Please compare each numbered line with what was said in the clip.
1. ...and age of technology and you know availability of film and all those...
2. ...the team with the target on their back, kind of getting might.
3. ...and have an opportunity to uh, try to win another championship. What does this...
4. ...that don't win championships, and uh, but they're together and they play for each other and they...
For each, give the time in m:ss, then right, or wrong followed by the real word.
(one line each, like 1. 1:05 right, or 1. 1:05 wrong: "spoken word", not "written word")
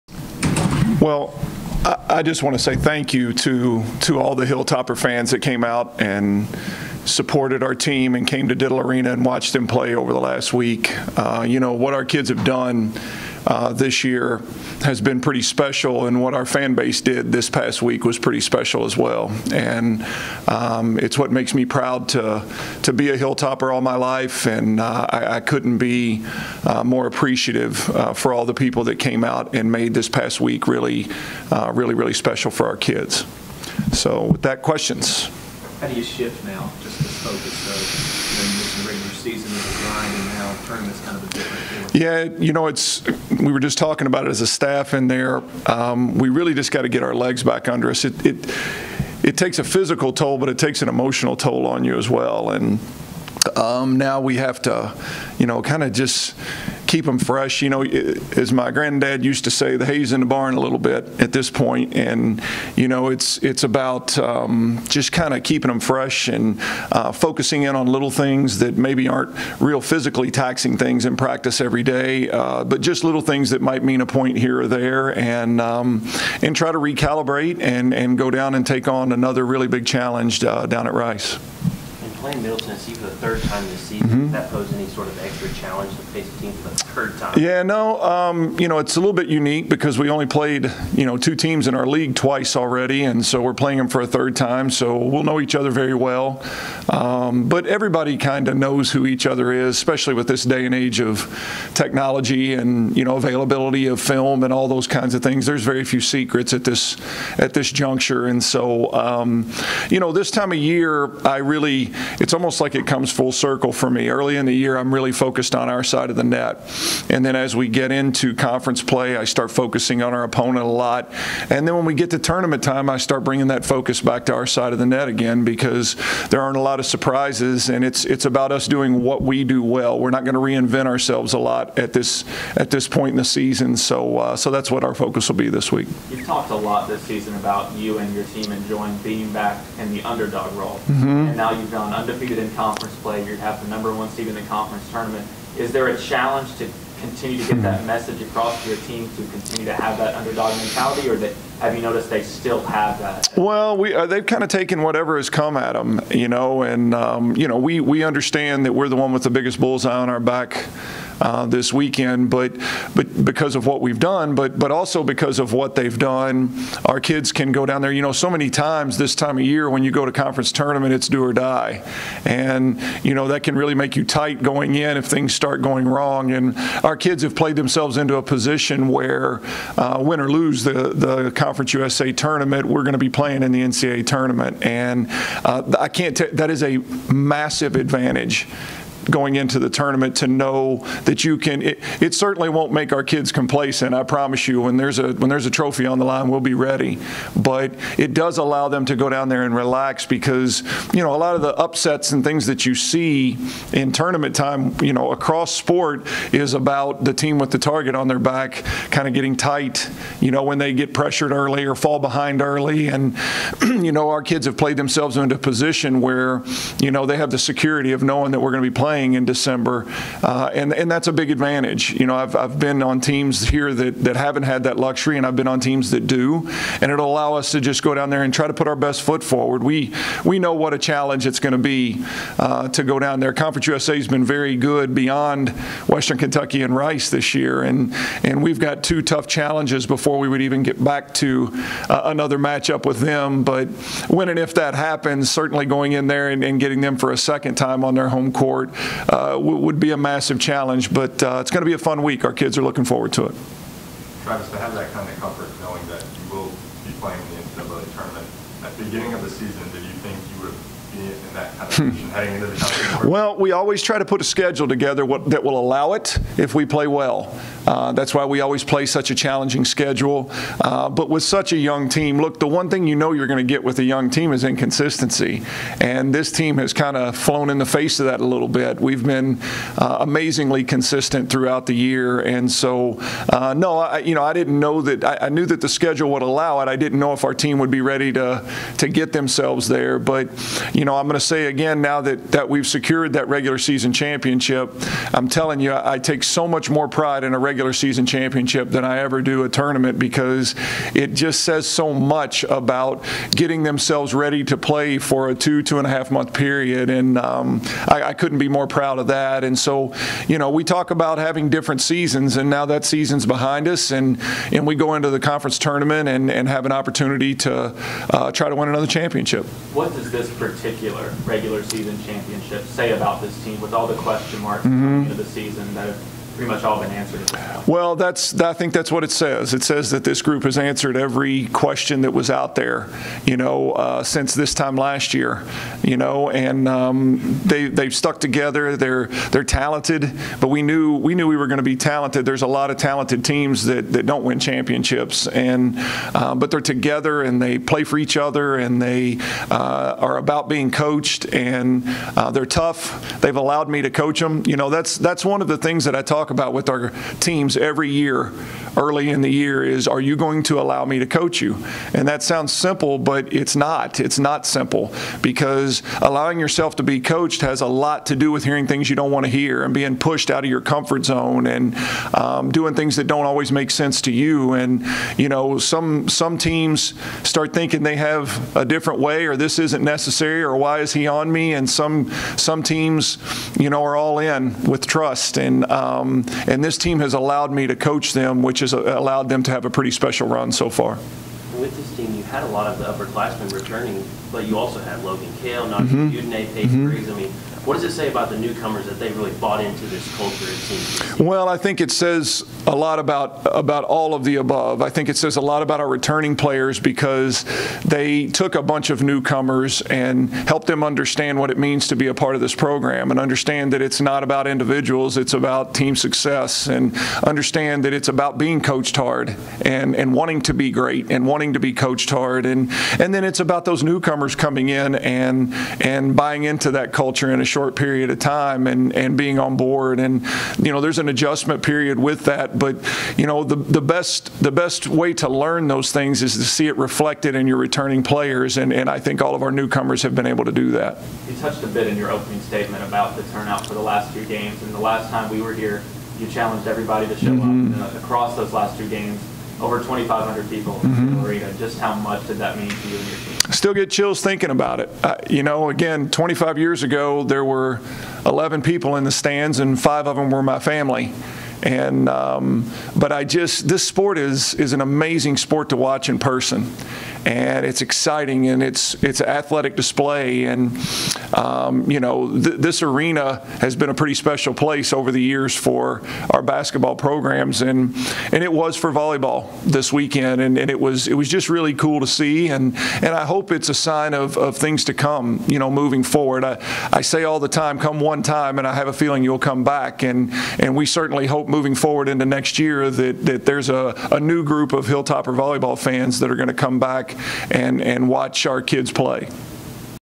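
1. 1:40 right
2. 3:27 wrong: "tight", not "might"
3. 5:16 right
4. 5:43 right.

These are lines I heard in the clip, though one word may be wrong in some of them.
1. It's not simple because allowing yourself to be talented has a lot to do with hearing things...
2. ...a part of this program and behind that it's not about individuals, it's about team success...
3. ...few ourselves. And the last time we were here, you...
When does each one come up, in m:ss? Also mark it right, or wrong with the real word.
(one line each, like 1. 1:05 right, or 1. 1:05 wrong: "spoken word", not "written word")
1. 6:03 wrong: "coached", not "talented"
2. 6:52 wrong: "understand", not "behind"
3. 7:24 wrong: "games", not "ourselves".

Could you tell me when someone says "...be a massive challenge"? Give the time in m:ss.
4:09.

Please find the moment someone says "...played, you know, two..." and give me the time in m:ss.
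1:30.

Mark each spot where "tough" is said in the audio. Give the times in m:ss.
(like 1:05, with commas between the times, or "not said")
3:59, 5:52.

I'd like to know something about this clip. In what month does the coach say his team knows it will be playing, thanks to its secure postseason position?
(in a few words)
December.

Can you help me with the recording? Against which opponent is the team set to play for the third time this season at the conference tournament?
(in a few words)
Middle Tennessee.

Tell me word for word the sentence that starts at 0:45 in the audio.
Um, we really just got to get our legs back under us.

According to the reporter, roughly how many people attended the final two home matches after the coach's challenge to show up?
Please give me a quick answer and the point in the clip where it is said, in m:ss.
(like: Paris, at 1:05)
2,500, at 7:29.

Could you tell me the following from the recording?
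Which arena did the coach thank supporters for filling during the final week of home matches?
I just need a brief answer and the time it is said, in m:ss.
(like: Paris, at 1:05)
Diddle Arena, at 0:08.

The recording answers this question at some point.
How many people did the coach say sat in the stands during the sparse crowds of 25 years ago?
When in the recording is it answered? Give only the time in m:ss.
7:38.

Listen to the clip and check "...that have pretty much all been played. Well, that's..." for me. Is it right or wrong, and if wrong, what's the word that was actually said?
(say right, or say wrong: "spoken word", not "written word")
wrong: "answered", not "played".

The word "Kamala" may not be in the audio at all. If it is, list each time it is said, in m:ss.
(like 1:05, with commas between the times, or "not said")
not said.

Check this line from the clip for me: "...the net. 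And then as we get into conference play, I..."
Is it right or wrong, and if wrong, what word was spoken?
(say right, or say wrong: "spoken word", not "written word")
right.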